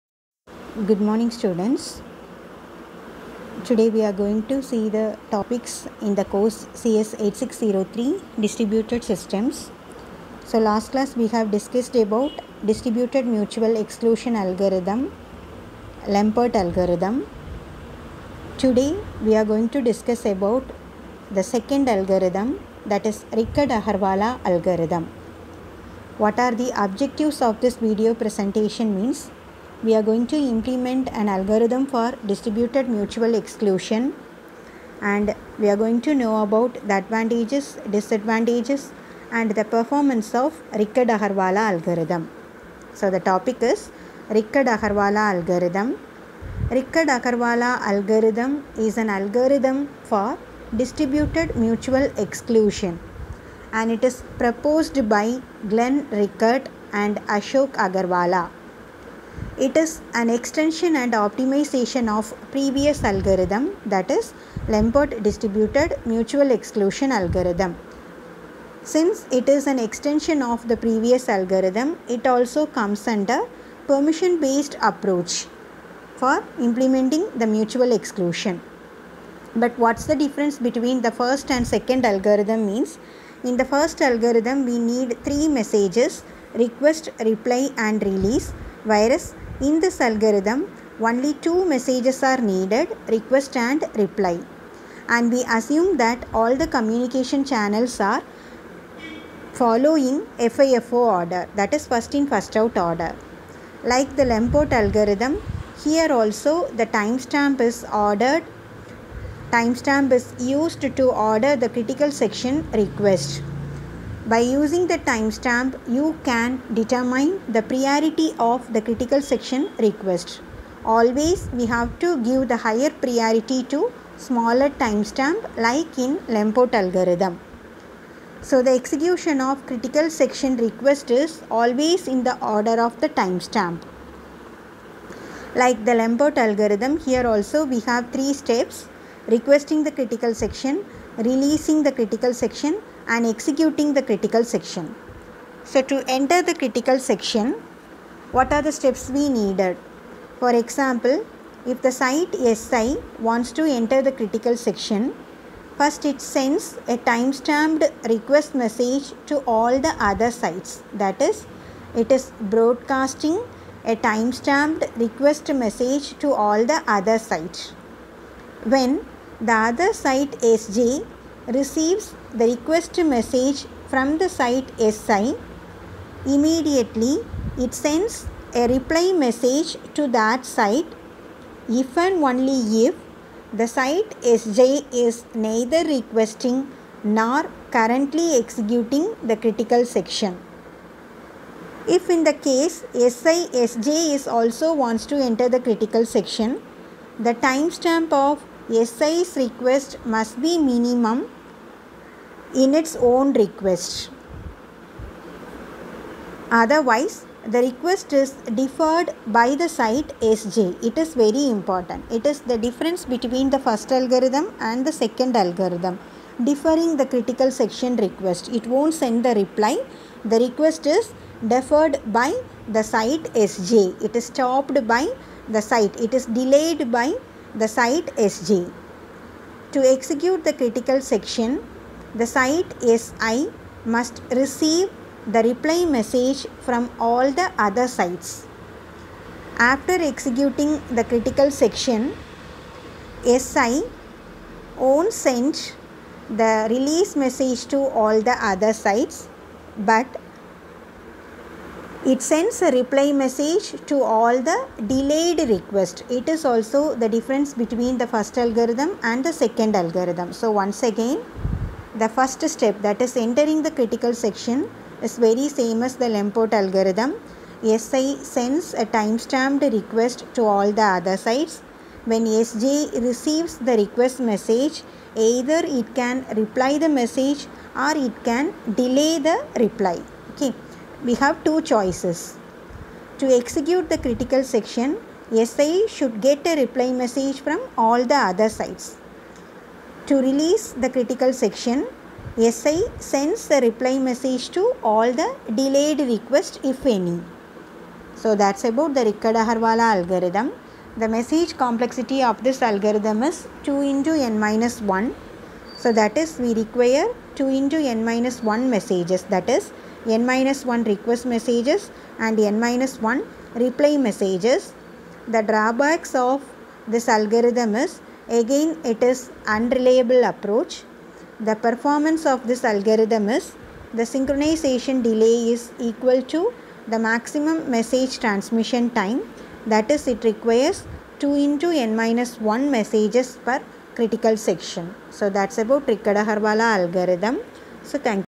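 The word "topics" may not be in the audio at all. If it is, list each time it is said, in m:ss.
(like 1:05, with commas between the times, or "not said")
0:05, 0:43.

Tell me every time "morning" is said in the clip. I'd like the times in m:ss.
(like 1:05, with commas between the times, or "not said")
0:01.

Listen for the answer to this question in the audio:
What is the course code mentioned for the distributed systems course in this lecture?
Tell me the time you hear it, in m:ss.
0:06.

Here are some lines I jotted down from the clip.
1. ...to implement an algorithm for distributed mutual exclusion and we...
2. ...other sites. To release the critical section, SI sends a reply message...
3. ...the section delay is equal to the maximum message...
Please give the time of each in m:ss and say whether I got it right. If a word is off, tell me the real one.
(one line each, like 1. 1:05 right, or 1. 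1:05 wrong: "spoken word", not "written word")
1. 0:30 right
2. 4:48 right
3. 5:23 wrong: "synchronization", not "section".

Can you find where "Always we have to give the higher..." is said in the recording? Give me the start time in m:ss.
2:00.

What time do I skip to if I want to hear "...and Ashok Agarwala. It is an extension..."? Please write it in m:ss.
0:56.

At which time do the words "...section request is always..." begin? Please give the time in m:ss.
2:10.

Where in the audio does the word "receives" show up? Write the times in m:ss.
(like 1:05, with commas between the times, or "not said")
2:51, 3:54, 4:33.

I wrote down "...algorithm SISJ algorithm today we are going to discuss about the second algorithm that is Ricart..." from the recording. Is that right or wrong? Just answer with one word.
wrong.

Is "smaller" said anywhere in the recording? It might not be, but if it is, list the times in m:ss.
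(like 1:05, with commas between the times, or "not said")
2:04.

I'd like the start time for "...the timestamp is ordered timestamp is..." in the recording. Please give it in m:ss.
1:46.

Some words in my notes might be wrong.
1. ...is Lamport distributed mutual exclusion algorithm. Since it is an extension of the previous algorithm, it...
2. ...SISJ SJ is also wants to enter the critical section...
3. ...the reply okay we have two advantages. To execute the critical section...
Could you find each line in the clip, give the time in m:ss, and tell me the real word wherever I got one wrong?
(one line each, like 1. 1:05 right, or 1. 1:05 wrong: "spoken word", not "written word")
1. 1:04 right
2. 3:12 right
3. 4:39 wrong: "choices", not "advantages".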